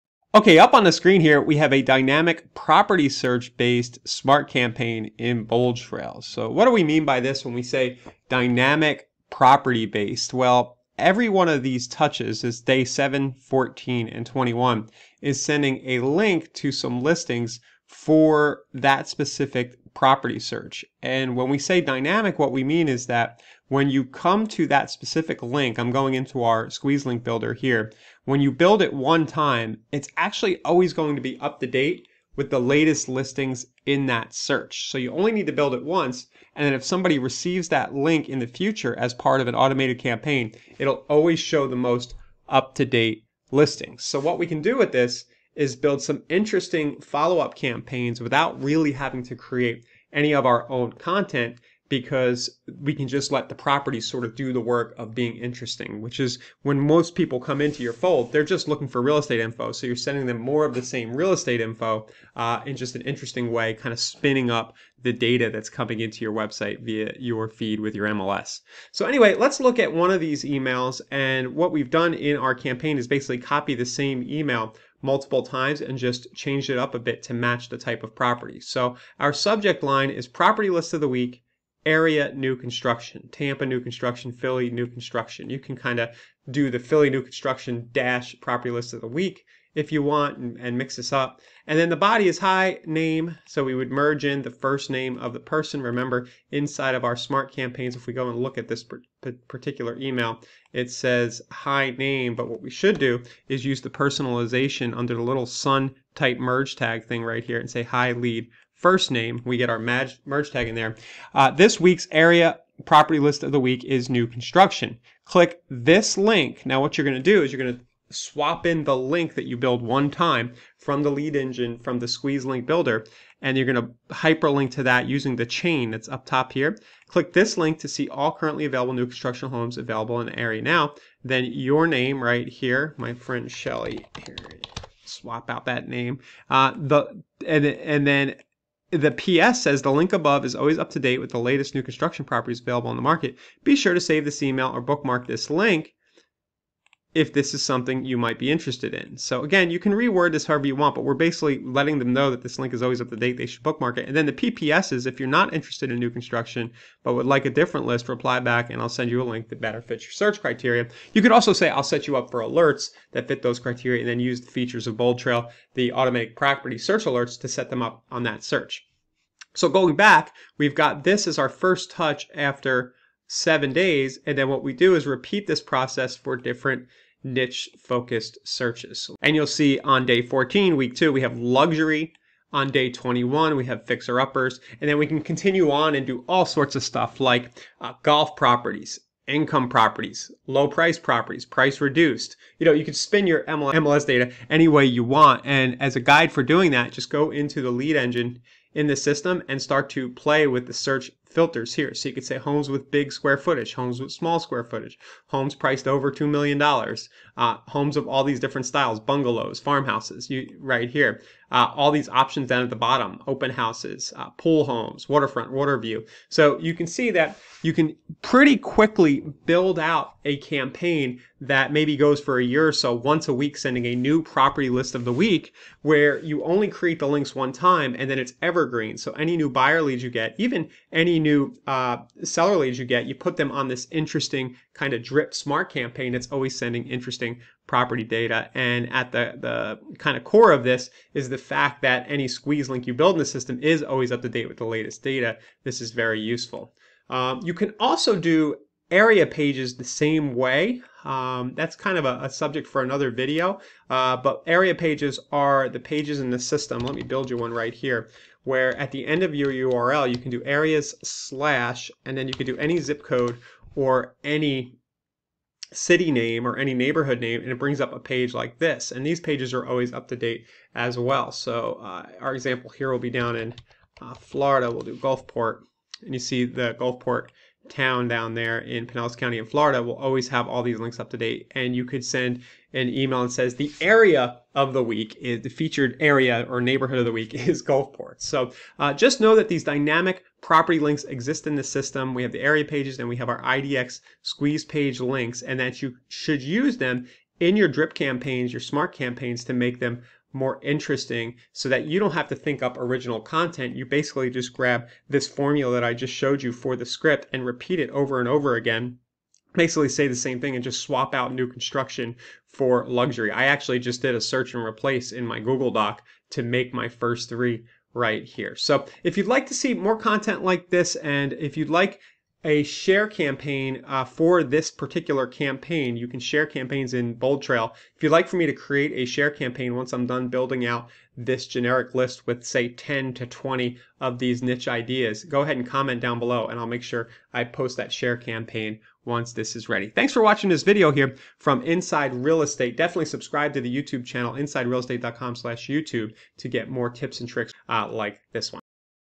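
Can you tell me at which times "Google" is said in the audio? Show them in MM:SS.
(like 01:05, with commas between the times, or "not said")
05:15.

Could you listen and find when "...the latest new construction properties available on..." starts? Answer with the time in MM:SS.
02:21.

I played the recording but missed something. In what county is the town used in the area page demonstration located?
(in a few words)
Pinellas County.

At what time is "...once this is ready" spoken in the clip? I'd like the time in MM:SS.
05:39.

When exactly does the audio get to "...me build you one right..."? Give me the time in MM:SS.
04:16.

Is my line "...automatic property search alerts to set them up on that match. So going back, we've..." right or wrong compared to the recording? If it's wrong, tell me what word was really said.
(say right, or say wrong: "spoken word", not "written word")
wrong: "search", not "match".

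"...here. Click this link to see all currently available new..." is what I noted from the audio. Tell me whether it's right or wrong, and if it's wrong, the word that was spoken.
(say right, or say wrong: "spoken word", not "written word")
right.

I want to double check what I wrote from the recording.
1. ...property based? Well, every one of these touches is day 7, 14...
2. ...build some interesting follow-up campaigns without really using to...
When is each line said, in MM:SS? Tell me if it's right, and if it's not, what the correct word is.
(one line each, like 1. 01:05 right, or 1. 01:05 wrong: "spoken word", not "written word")
1. 00:09 right
2. 00:45 wrong: "having", not "using".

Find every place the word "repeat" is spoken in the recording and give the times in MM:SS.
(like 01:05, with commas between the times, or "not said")
02:55, 05:07.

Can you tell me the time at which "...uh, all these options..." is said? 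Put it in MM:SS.
03:31.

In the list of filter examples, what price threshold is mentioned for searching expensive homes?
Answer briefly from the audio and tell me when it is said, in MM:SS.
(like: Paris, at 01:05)
$2 million, at 03:26.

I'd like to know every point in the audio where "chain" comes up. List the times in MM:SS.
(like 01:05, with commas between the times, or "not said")
02:05.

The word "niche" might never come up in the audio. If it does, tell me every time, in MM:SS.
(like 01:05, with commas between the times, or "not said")
02:57, 05:34.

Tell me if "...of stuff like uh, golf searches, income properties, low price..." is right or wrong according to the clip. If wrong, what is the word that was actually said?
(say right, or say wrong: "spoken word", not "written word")
wrong: "properties", not "searches".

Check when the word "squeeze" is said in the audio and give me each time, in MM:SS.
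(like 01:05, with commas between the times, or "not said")
00:26, 02:02, 04:02, 04:54.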